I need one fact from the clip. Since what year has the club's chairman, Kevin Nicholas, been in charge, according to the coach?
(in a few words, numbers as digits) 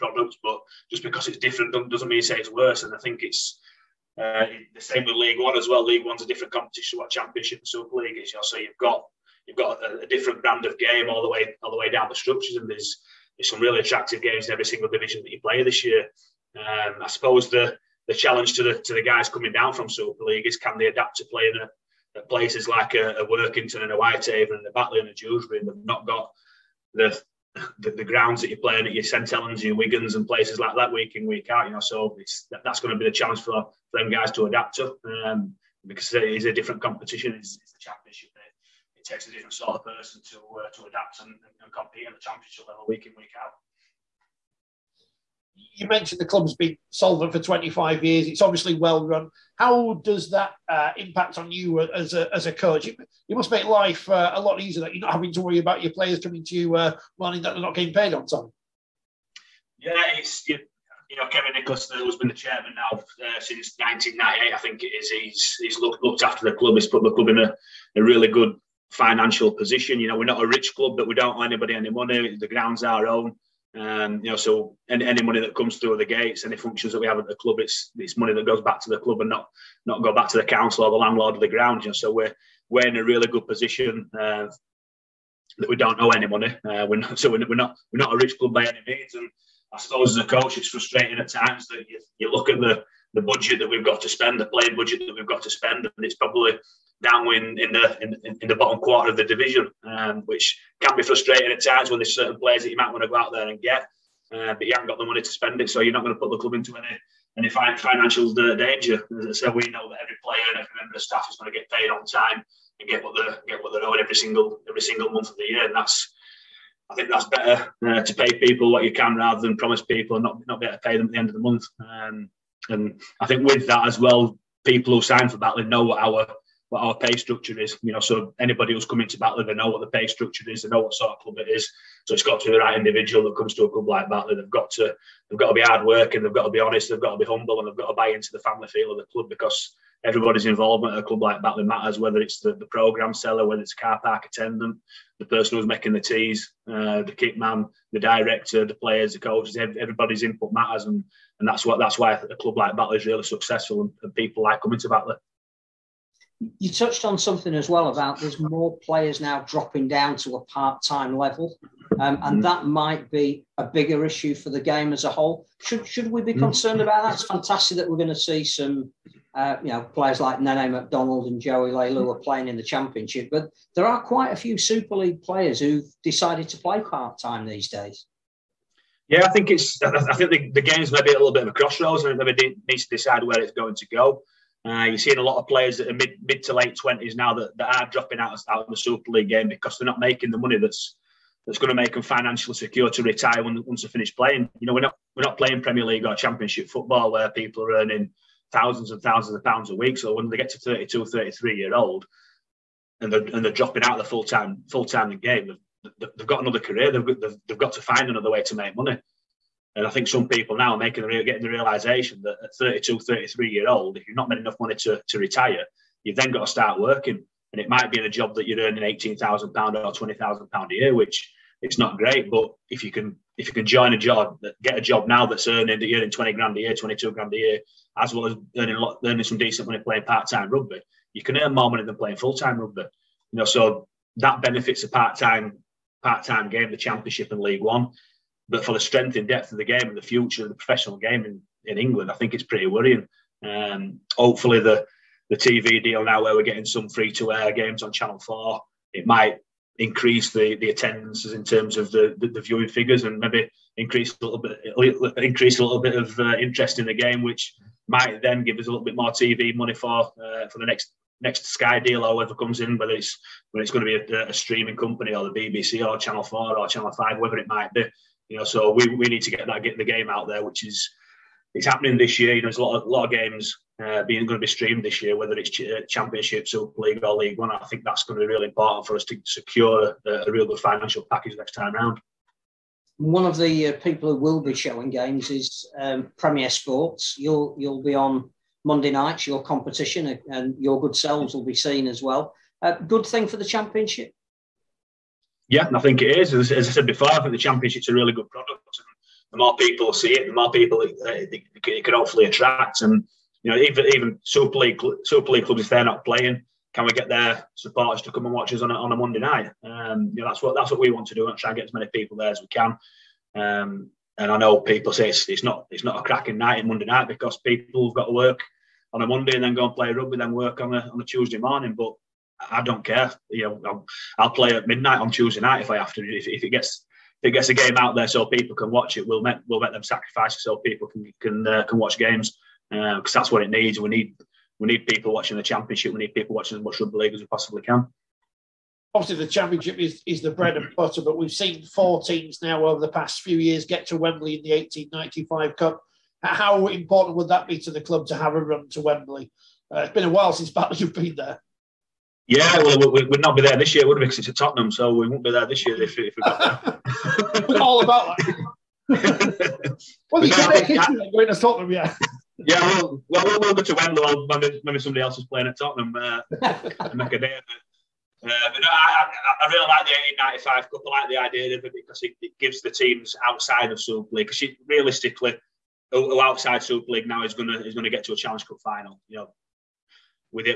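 1998.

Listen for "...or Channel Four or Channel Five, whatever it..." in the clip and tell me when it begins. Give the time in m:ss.
4:25.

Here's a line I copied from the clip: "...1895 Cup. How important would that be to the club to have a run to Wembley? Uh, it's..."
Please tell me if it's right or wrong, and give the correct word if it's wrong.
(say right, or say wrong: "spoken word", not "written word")
right.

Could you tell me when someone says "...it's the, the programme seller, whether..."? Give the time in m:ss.
2:22.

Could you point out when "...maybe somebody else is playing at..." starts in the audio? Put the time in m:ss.
6:04.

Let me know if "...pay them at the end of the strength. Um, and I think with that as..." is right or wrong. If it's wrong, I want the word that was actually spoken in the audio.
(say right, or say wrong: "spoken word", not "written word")
wrong: "month", not "strength".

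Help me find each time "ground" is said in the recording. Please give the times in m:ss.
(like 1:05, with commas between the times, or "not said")
0:28, 1:12, 1:21.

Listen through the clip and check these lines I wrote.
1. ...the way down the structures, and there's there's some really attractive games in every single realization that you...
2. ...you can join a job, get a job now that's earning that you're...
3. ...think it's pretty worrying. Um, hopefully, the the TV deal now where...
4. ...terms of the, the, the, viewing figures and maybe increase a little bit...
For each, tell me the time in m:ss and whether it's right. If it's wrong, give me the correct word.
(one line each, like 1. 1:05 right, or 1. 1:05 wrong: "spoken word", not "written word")
1. 0:11 wrong: "division", not "realization"
2. 3:43 right
3. 4:02 right
4. 4:11 right.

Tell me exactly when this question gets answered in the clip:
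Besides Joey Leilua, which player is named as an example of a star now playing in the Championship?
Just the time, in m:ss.
2:50.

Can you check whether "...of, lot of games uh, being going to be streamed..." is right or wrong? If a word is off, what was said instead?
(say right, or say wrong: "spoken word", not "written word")
right.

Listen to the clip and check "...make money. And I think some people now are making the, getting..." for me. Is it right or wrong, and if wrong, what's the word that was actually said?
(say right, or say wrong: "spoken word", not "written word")
right.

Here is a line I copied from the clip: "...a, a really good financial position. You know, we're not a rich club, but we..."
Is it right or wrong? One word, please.
right.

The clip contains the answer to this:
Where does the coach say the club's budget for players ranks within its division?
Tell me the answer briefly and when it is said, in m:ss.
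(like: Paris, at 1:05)
bottom quarter, at 1:38.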